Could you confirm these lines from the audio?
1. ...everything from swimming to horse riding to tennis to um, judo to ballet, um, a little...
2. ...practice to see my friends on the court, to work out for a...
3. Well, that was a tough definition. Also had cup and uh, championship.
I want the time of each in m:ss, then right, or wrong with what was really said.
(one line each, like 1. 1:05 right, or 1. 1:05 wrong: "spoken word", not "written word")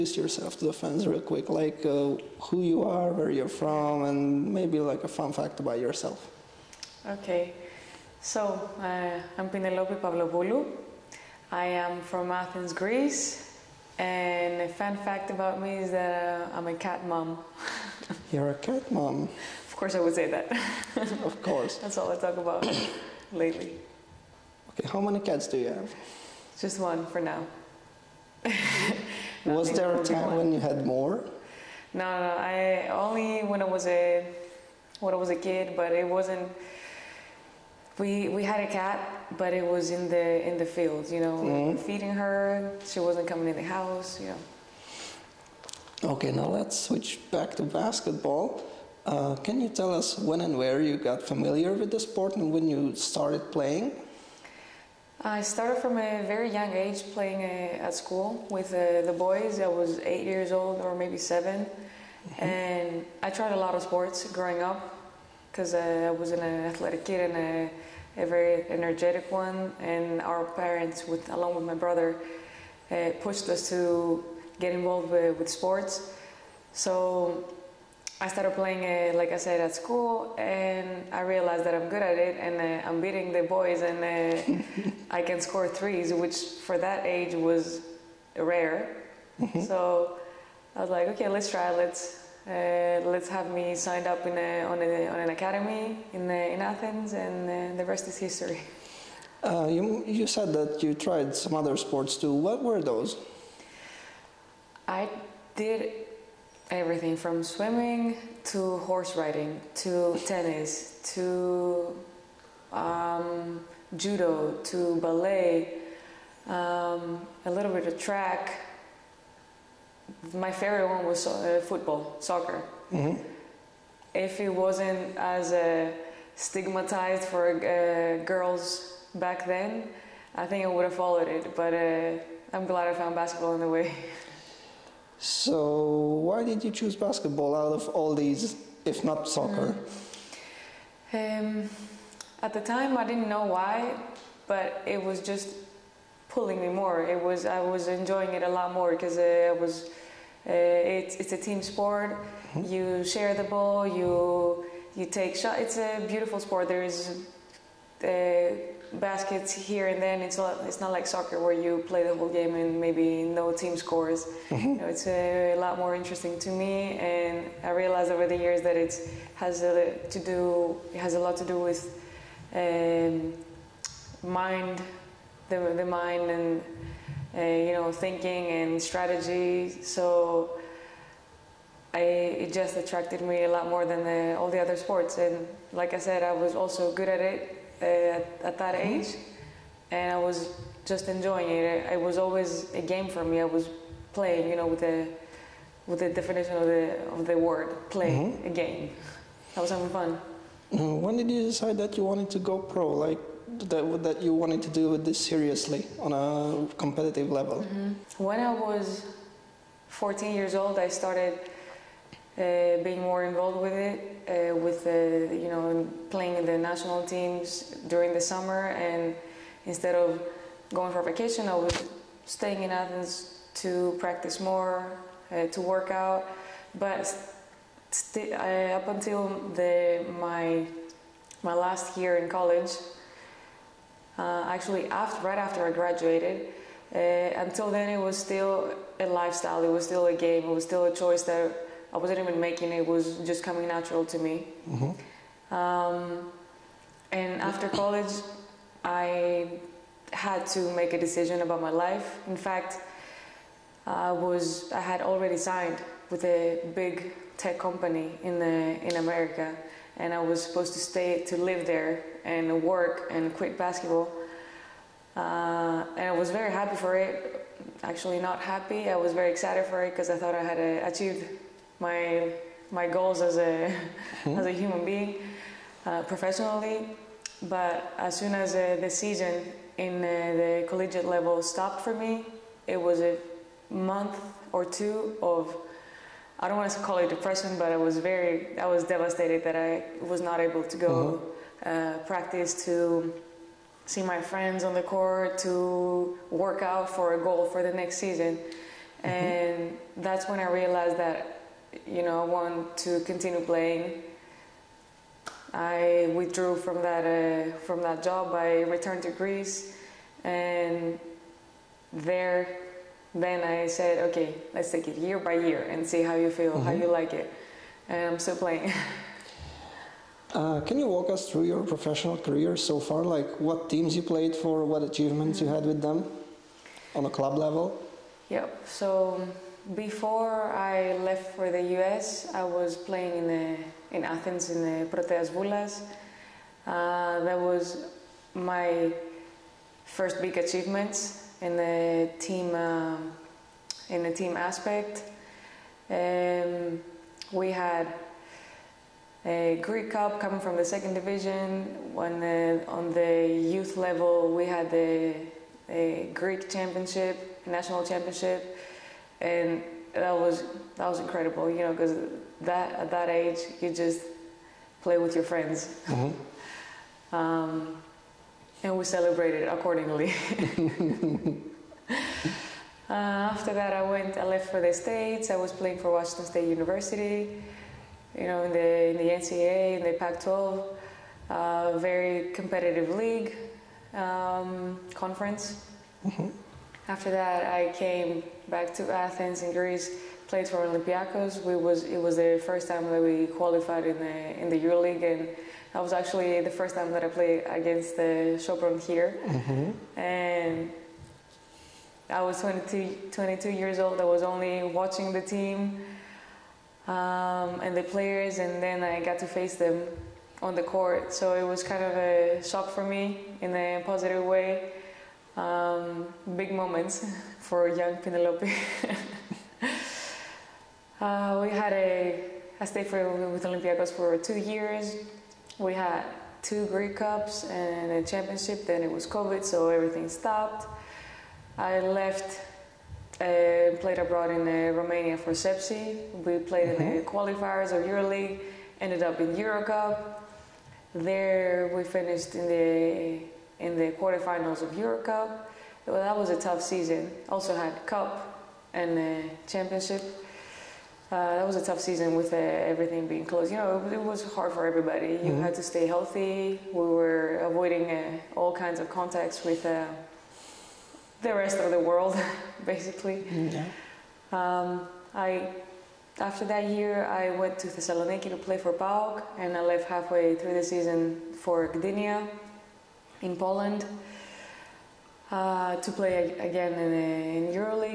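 1. 1:46 right
2. 4:52 right
3. 7:25 wrong: "season", not "definition".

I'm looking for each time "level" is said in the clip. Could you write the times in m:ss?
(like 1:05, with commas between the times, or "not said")
3:27, 4:41, 5:27, 5:53.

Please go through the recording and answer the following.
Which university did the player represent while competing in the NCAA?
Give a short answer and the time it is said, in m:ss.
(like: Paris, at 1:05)
Washington State University, at 6:15.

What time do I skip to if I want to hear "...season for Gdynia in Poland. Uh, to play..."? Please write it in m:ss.
7:50.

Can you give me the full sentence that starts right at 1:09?
And our parents, with, along with my brother, uh, pushed us to get involved with, with sports.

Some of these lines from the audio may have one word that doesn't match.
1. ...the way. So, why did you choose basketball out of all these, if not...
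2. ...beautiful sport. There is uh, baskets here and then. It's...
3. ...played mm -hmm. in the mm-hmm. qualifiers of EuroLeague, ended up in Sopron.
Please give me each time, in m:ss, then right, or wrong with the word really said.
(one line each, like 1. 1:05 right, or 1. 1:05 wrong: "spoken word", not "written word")
1. 2:13 right
2. 2:36 right
3. 7:16 wrong: "EuroCup", not "Sopron".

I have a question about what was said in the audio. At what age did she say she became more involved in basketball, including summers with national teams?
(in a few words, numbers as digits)
14.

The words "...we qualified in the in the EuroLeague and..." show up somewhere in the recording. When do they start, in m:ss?
6:33.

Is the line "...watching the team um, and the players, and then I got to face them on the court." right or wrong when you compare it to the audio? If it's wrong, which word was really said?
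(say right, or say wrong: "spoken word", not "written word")
right.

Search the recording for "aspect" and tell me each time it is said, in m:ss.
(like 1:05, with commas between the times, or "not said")
5:44.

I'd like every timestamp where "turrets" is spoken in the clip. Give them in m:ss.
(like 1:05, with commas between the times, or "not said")
not said.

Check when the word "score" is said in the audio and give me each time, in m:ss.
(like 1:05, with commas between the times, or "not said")
1:25, 2:43.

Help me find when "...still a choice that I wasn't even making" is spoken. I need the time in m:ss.
4:00.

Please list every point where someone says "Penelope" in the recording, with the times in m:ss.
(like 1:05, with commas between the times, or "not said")
0:09, 6:57.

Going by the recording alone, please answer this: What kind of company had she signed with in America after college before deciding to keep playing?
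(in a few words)
Big tech company.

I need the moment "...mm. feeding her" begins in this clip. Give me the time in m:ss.
0:41.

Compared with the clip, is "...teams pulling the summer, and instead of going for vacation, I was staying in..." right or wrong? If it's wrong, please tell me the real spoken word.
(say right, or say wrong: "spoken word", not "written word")
wrong: "during", not "pulling".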